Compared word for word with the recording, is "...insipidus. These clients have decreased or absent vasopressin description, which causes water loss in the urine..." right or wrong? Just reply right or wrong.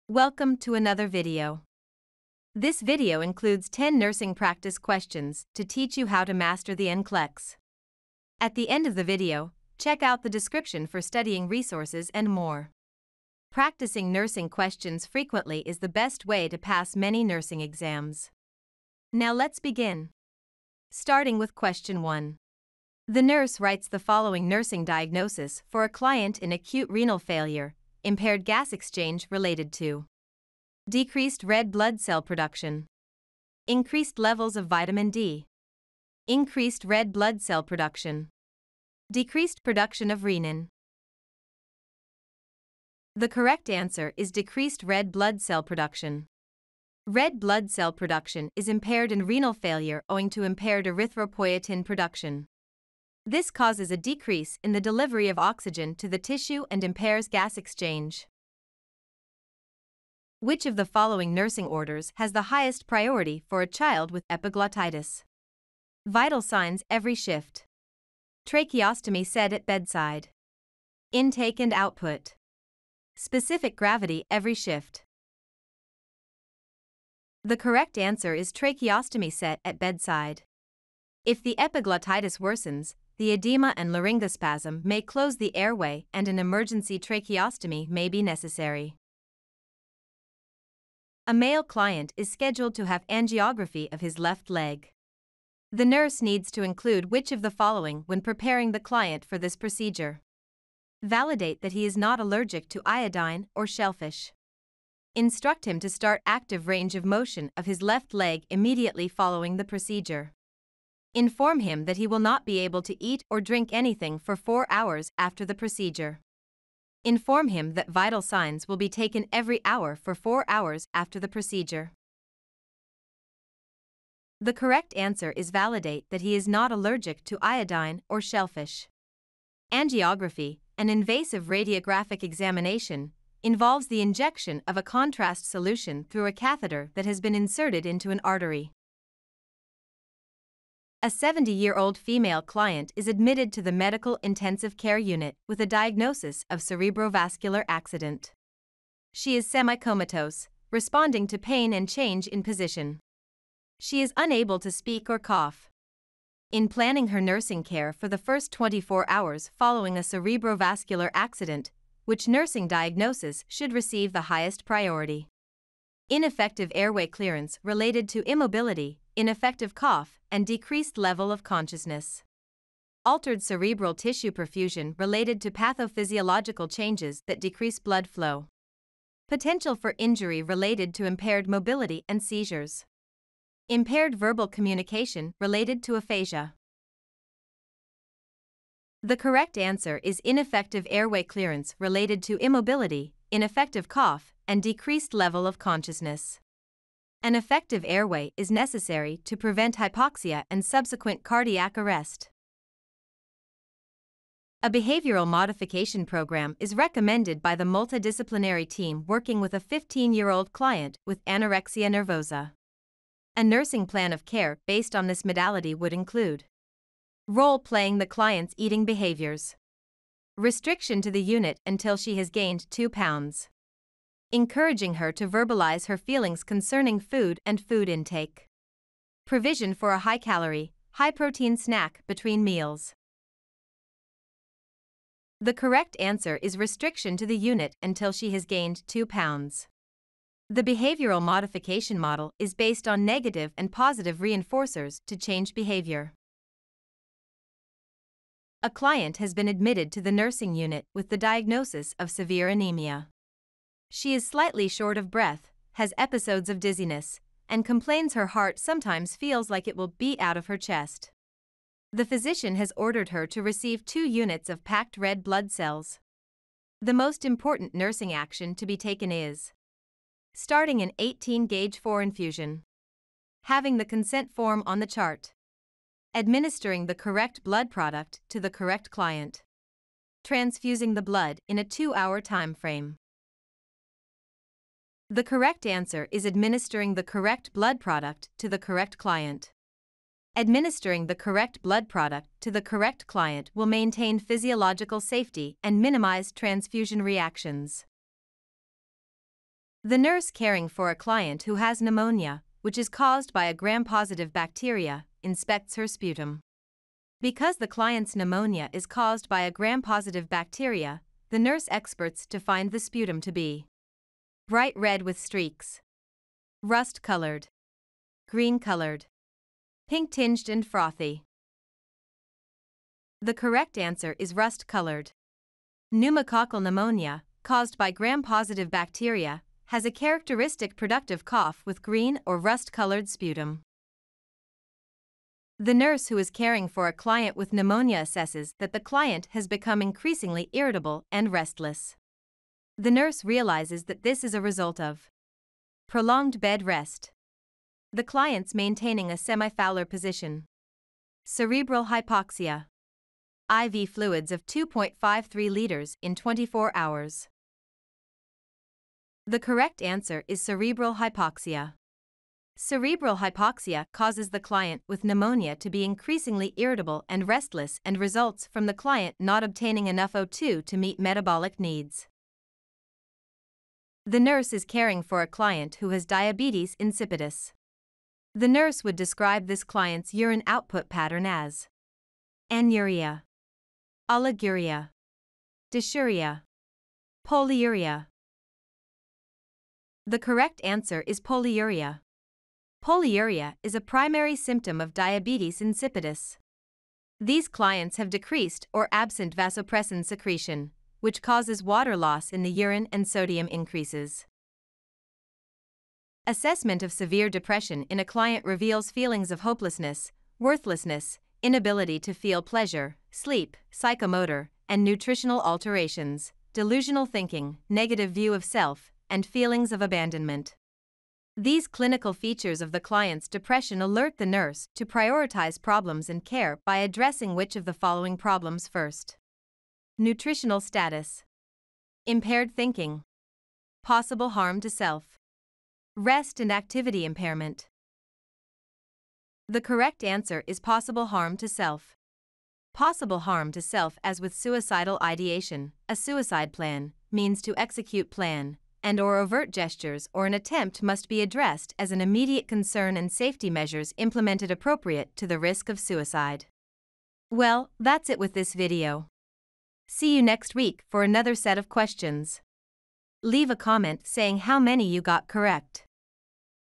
wrong.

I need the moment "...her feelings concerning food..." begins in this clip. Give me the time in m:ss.
3:45.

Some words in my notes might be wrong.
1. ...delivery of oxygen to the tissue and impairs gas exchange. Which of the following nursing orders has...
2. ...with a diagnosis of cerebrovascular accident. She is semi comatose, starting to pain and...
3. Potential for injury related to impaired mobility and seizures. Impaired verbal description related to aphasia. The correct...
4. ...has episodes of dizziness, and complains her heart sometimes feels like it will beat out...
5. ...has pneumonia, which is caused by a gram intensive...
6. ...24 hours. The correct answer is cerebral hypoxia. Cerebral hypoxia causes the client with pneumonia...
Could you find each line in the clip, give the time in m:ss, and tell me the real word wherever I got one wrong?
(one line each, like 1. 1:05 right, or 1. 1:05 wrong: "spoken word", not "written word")
1. 0:54 right
2. 2:25 wrong: "responding", not "starting"
3. 2:59 wrong: "communication", not "description"
4. 4:15 right
5. 5:01 wrong: "positive", not "intensive"
6. 5:56 right.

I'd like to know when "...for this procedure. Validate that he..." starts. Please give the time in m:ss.
1:39.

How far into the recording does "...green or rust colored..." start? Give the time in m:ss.
5:31.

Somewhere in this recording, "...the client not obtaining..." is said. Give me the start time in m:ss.
6:08.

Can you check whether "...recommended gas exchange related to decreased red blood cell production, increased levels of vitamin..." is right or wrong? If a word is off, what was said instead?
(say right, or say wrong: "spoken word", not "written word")
wrong: "impaired", not "recommended".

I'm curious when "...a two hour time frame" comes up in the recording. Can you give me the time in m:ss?
4:41.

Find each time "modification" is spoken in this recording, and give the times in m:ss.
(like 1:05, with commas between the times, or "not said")
3:25, 4:01.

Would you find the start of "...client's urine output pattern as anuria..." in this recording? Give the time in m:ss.
6:19.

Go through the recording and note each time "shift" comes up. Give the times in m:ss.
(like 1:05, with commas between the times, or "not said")
1:07, 1:14.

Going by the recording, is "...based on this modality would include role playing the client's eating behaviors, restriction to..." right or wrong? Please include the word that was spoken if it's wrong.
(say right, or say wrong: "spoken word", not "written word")
right.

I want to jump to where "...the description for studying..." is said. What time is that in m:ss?
0:10.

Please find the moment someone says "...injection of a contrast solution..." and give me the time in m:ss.
2:14.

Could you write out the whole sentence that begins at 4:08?
A client has been admitted to the nursing unit with the diagnosis of severe anemia.